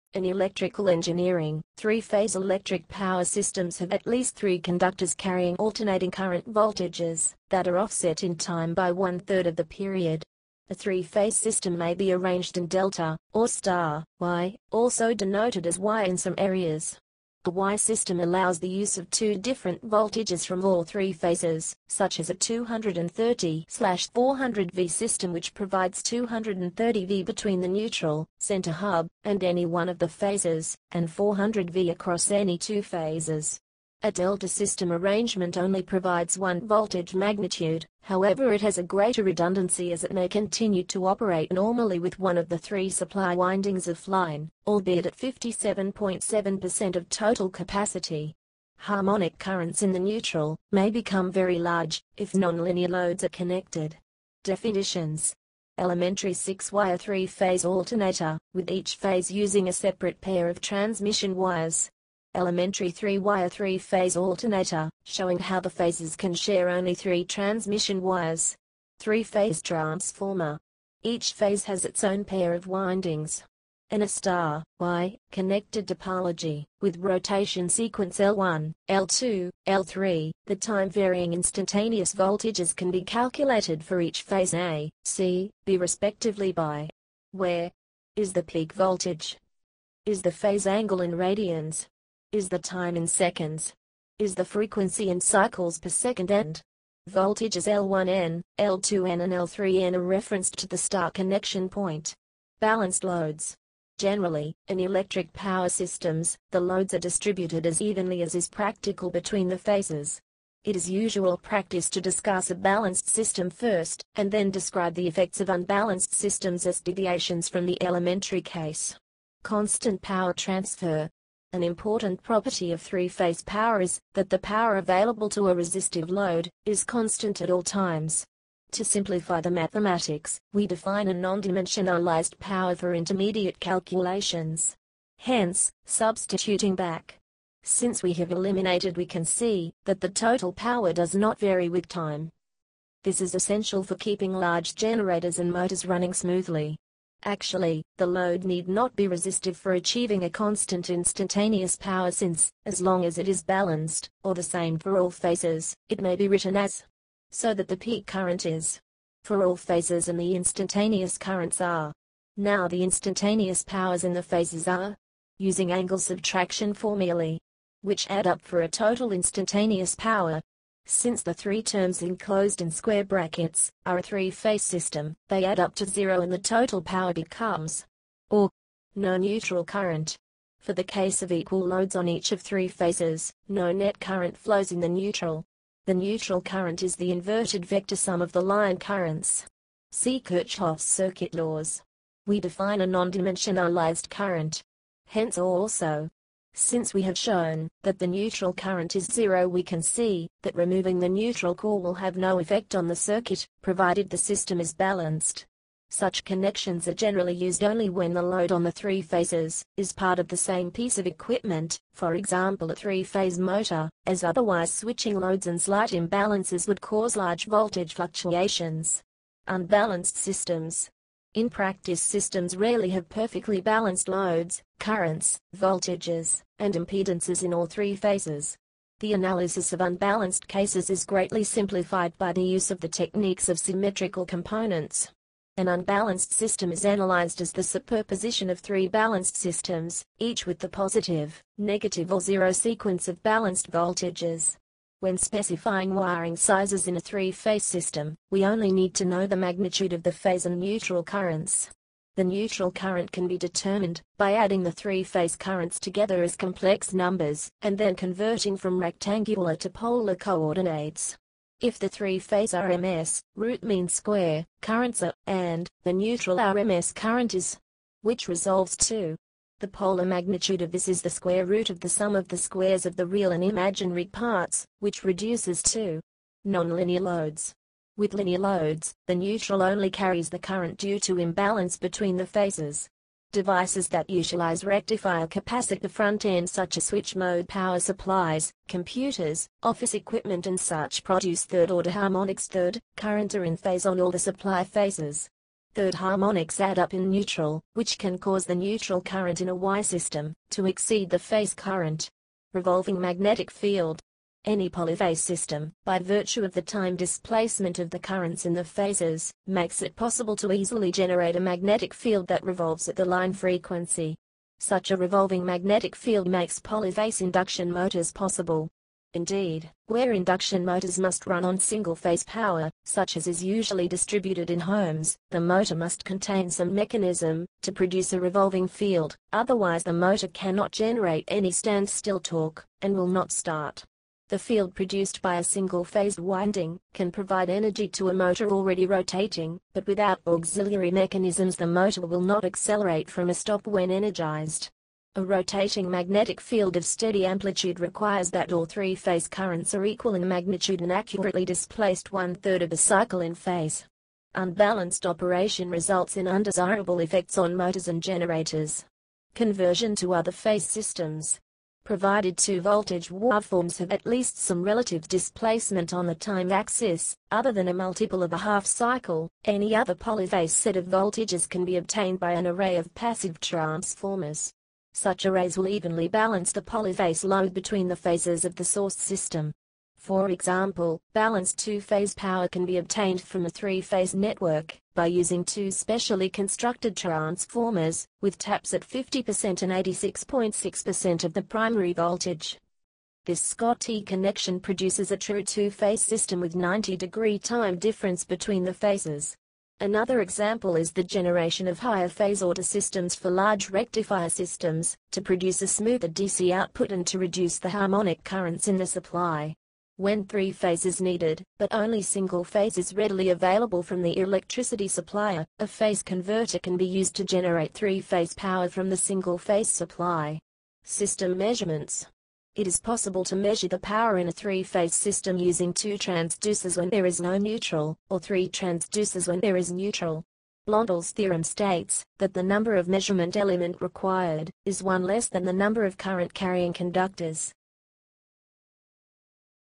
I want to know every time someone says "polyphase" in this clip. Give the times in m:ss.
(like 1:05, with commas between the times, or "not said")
5:04, 5:16, 6:09, 6:16.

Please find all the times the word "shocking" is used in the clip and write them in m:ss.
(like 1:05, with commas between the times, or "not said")
not said.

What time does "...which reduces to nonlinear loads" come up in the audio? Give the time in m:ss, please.
4:34.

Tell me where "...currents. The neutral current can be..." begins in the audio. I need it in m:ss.
4:11.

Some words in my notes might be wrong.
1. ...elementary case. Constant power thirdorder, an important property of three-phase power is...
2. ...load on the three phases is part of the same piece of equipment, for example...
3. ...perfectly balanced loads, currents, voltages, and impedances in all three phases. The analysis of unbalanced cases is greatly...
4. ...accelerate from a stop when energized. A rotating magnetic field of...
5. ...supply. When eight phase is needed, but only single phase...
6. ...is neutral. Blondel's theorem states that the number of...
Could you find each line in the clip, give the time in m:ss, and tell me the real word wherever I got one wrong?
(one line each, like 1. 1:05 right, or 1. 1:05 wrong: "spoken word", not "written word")
1. 1:57 wrong: "transfer", not "thirdorder"
2. 3:28 right
3. 3:43 right
4. 5:42 right
5. 6:48 wrong: "three", not "eight"
6. 7:09 right.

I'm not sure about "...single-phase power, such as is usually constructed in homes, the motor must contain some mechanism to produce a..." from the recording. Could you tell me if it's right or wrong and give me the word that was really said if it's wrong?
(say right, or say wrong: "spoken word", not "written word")
wrong: "distributed", not "constructed".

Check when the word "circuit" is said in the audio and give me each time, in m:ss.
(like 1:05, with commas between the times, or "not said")
3:10, 3:22.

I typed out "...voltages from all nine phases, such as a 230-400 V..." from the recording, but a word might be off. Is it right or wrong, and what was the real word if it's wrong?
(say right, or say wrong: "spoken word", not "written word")
wrong: "three", not "nine".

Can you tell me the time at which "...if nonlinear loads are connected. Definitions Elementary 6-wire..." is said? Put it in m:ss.
0:52.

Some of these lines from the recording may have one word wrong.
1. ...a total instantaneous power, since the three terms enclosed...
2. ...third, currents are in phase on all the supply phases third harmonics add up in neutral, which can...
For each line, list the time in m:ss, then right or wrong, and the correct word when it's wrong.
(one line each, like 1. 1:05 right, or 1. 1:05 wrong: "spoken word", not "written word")
1. 2:48 right
2. 4:52 right.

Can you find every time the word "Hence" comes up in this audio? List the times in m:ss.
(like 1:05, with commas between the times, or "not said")
2:15, 3:15.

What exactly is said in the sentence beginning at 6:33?
This T connection produces a true two-phase system with 90 degree time difference between the phases.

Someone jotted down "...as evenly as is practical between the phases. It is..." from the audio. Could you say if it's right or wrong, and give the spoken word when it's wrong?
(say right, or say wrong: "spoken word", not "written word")
right.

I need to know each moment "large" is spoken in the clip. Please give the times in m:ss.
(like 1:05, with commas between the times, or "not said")
0:51, 2:24, 3:37, 6:43.